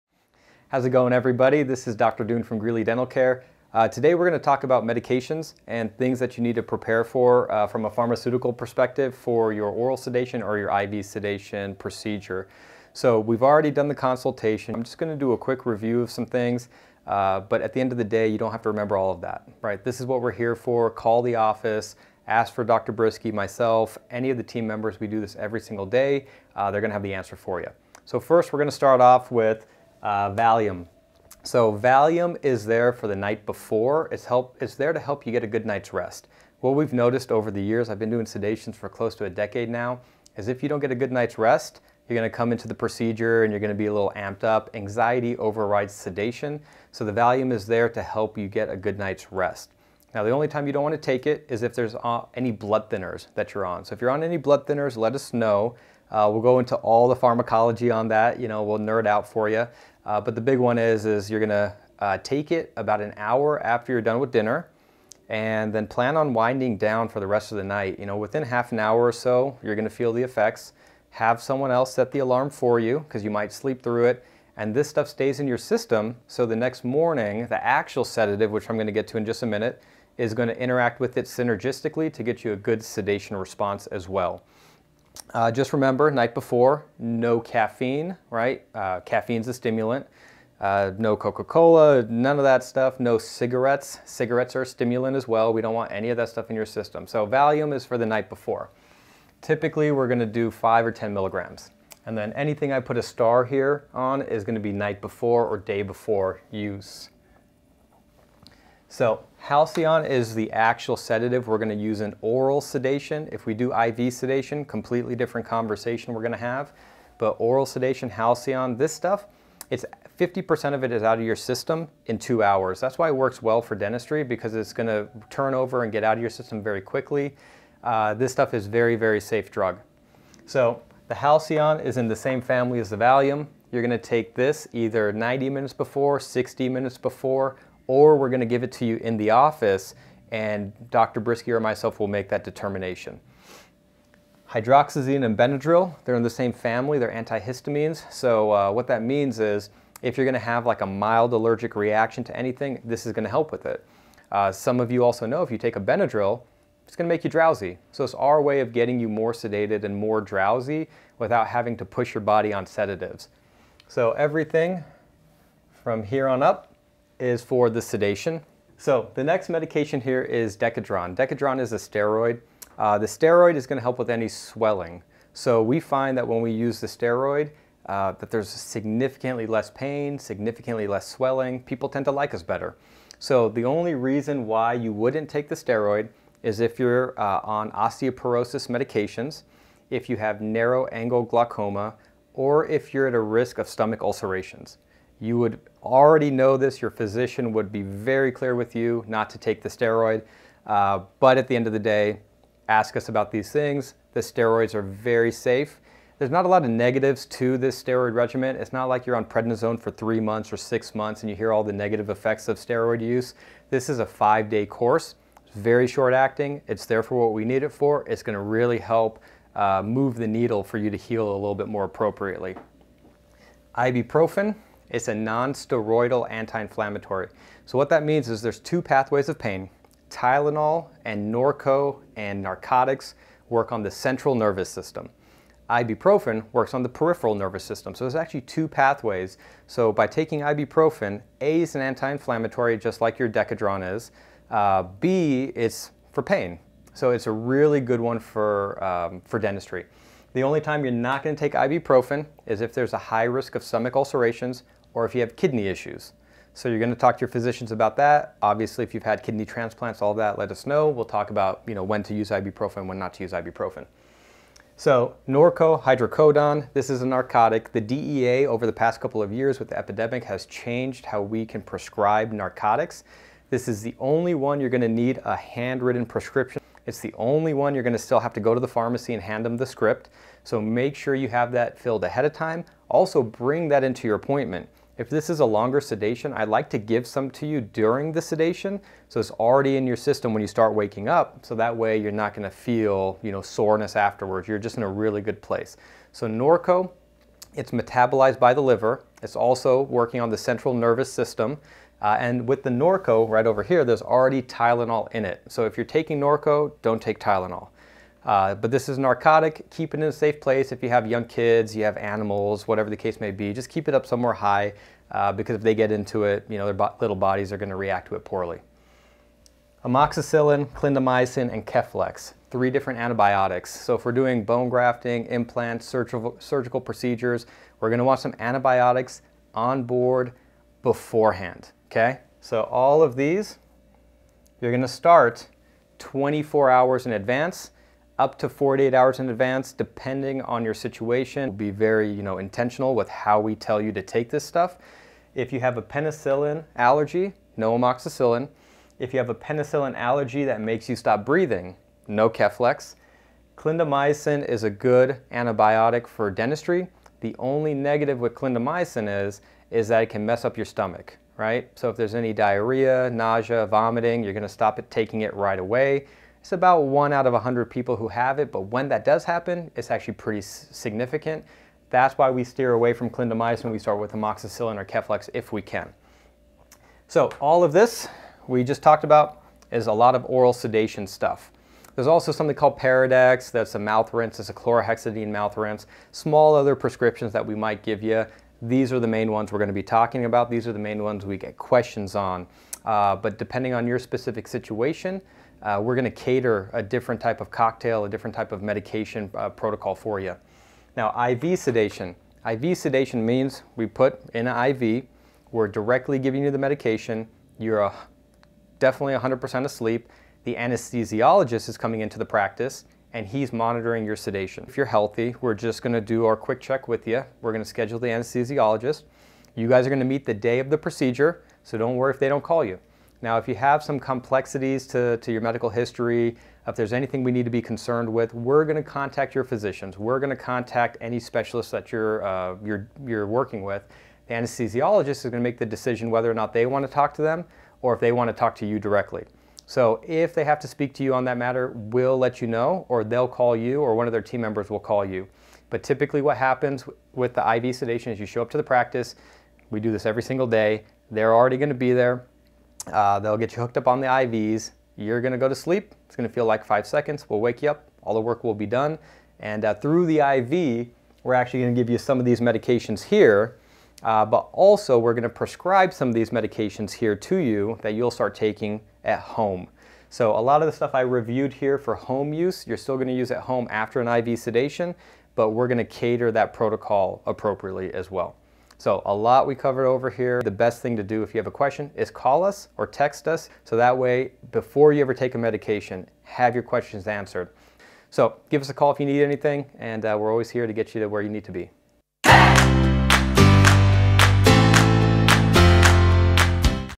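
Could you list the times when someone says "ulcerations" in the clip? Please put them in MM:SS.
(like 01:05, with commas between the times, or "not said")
03:14, 04:13.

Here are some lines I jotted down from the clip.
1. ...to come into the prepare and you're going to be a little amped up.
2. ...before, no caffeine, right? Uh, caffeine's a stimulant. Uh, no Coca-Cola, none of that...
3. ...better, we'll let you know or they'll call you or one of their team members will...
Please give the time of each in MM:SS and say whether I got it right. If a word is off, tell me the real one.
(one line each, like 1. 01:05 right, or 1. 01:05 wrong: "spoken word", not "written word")
1. 00:42 wrong: "procedure", not "prepare"
2. 01:26 right
3. 07:21 wrong: "matter", not "better".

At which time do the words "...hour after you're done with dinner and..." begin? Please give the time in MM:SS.
01:03.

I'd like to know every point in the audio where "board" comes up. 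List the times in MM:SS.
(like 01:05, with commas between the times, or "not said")
05:29.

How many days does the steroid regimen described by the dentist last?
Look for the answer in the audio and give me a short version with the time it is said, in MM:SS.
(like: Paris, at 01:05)
5 days, at 03:34.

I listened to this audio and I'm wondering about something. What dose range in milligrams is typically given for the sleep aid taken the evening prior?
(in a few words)
5 or 10 milligrams.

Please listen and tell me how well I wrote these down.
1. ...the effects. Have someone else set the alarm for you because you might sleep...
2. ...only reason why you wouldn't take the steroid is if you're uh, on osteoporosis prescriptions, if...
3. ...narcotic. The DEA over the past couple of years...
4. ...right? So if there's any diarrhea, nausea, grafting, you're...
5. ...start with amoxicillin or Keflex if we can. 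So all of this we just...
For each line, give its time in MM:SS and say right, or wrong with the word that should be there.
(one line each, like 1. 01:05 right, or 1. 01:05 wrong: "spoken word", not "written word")
1. 01:10 right
2. 03:03 wrong: "medications", not "prescriptions"
3. 04:27 right
4. 06:01 wrong: "vomiting", not "grafting"
5. 06:13 right.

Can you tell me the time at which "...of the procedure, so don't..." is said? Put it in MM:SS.
07:00.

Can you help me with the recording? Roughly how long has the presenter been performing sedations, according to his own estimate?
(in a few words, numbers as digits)
close to a decade.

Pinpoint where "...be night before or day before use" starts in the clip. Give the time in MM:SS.
01:44.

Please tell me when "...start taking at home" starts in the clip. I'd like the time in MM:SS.
07:48.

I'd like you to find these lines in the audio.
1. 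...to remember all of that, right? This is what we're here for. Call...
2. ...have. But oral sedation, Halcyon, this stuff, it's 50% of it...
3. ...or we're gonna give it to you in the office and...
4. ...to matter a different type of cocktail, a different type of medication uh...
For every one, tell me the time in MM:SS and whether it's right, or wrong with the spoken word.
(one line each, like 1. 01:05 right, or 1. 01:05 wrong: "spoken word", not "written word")
1. 00:18 right
2. 01:56 right
3. 02:17 right
4. 06:36 wrong: "cater", not "matter".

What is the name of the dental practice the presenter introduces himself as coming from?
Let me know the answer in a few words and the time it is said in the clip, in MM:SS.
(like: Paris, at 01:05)
Greeley Dental Care, at 00:02.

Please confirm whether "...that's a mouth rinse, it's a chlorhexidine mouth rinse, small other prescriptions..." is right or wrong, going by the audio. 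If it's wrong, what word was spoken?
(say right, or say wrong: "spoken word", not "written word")
right.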